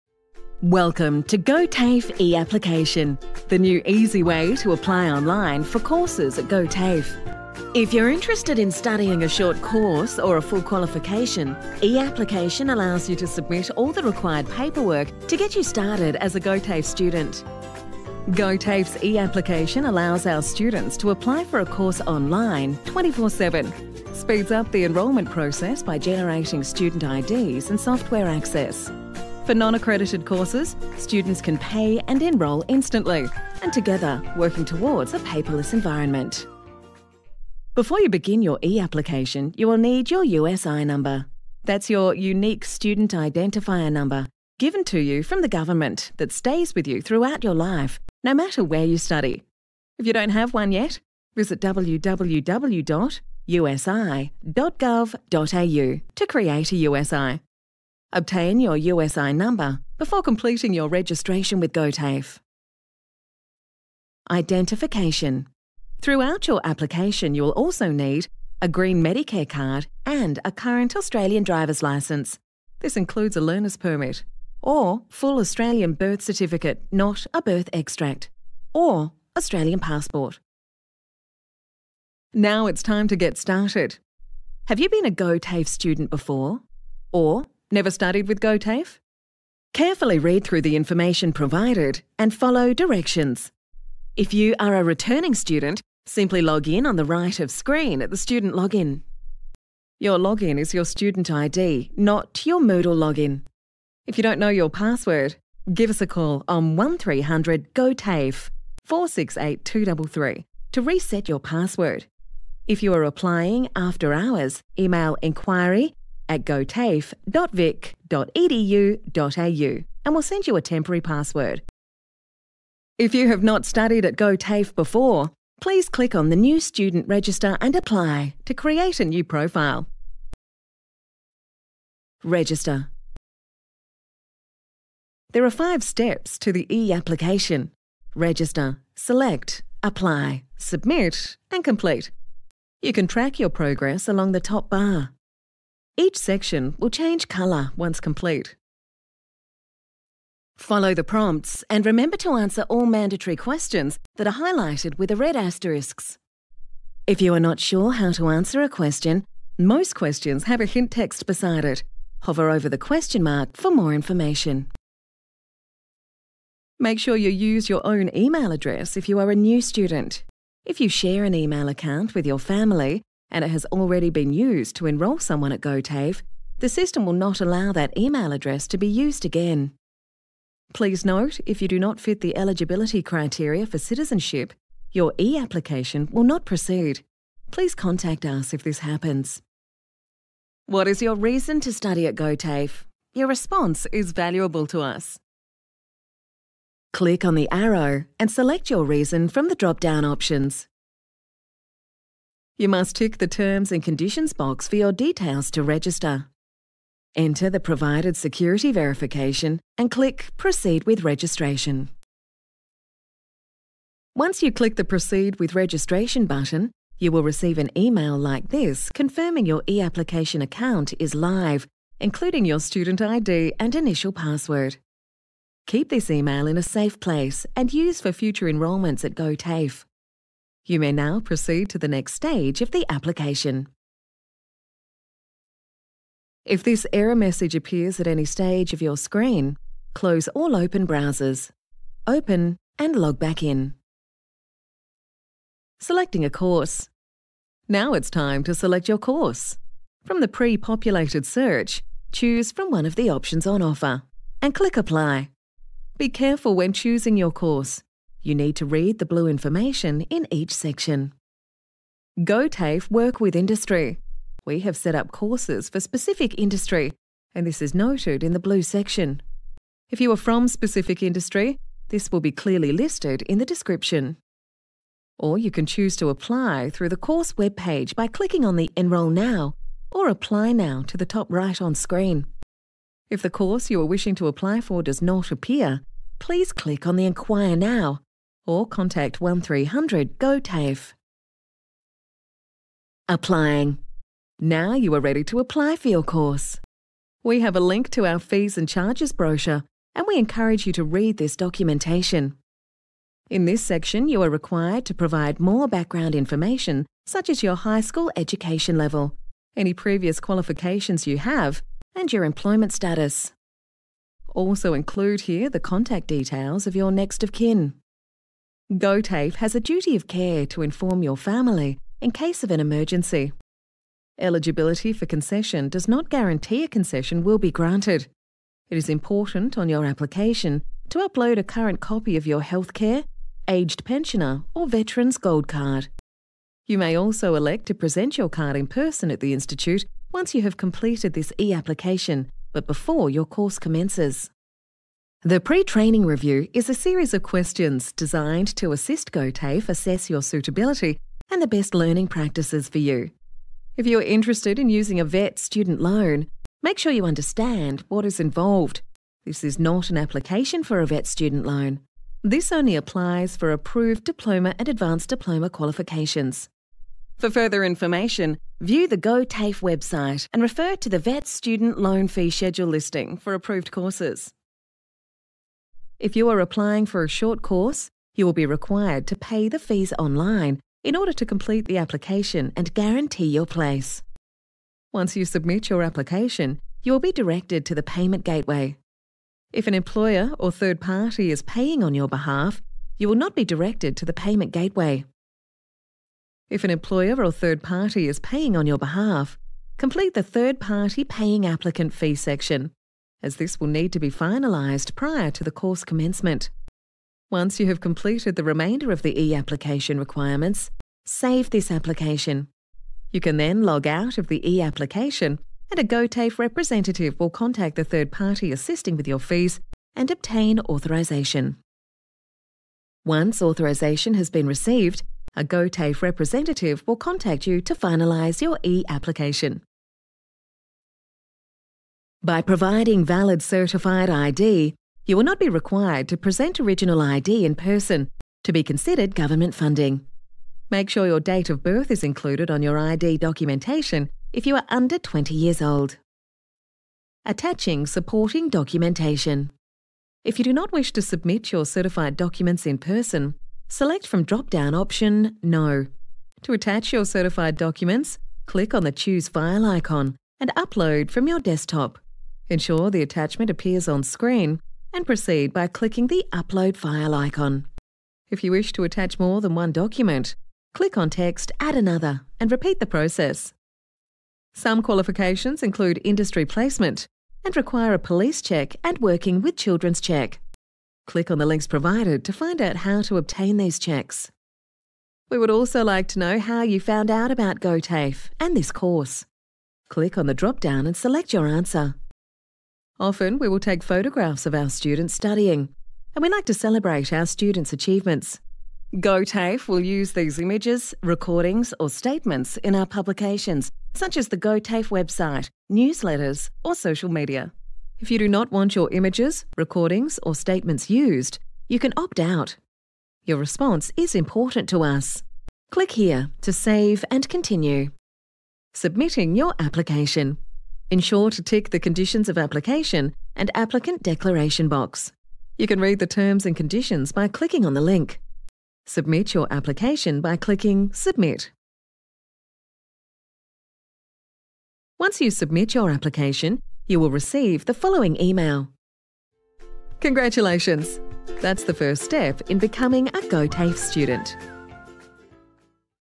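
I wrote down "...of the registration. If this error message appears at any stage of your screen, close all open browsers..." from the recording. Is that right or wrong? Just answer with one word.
wrong.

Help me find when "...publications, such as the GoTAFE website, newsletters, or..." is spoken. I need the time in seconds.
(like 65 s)
502 s.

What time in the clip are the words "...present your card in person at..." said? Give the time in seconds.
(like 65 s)
337 s.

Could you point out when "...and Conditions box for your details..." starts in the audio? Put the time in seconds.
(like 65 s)
203 s.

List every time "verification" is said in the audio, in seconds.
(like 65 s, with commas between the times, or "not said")
208 s.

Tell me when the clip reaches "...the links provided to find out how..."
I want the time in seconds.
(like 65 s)
481 s.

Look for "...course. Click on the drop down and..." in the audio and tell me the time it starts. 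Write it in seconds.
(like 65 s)
488 s.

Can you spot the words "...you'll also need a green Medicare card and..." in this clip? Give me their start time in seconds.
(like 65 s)
67 s.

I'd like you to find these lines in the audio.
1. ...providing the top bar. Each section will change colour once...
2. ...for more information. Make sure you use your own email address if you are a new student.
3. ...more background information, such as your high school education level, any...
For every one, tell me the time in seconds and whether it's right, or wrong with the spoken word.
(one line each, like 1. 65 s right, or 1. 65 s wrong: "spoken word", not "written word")
1. 144 s wrong: "along", not "providing"
2. 163 s right
3. 305 s right.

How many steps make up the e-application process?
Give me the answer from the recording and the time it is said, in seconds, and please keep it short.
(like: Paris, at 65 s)
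Five, at 135 s.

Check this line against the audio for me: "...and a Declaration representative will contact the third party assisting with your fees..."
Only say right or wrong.
wrong.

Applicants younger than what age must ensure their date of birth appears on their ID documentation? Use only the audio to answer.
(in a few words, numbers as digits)
20.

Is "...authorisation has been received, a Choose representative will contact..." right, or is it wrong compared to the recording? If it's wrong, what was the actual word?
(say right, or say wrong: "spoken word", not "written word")
wrong: "GoTAFE", not "Choose".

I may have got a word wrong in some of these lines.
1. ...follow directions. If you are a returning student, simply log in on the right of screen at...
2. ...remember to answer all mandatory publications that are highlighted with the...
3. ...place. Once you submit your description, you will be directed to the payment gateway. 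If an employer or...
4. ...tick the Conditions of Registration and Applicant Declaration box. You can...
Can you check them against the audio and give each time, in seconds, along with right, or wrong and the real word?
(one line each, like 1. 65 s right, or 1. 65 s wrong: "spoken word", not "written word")
1. 92 s right
2. 151 s wrong: "questions", not "publications"
3. 383 s wrong: "application", not "description"
4. 521 s wrong: "Application", not "Registration".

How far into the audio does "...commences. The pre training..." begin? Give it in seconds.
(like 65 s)
343 s.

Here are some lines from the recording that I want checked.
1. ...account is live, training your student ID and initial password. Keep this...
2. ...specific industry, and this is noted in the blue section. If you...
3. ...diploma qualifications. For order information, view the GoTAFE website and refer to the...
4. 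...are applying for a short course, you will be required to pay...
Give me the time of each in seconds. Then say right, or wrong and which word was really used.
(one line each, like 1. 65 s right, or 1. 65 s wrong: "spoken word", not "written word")
1. 220 s wrong: "including", not "training"
2. 265 s right
3. 365 s wrong: "further", not "order"
4. 376 s right.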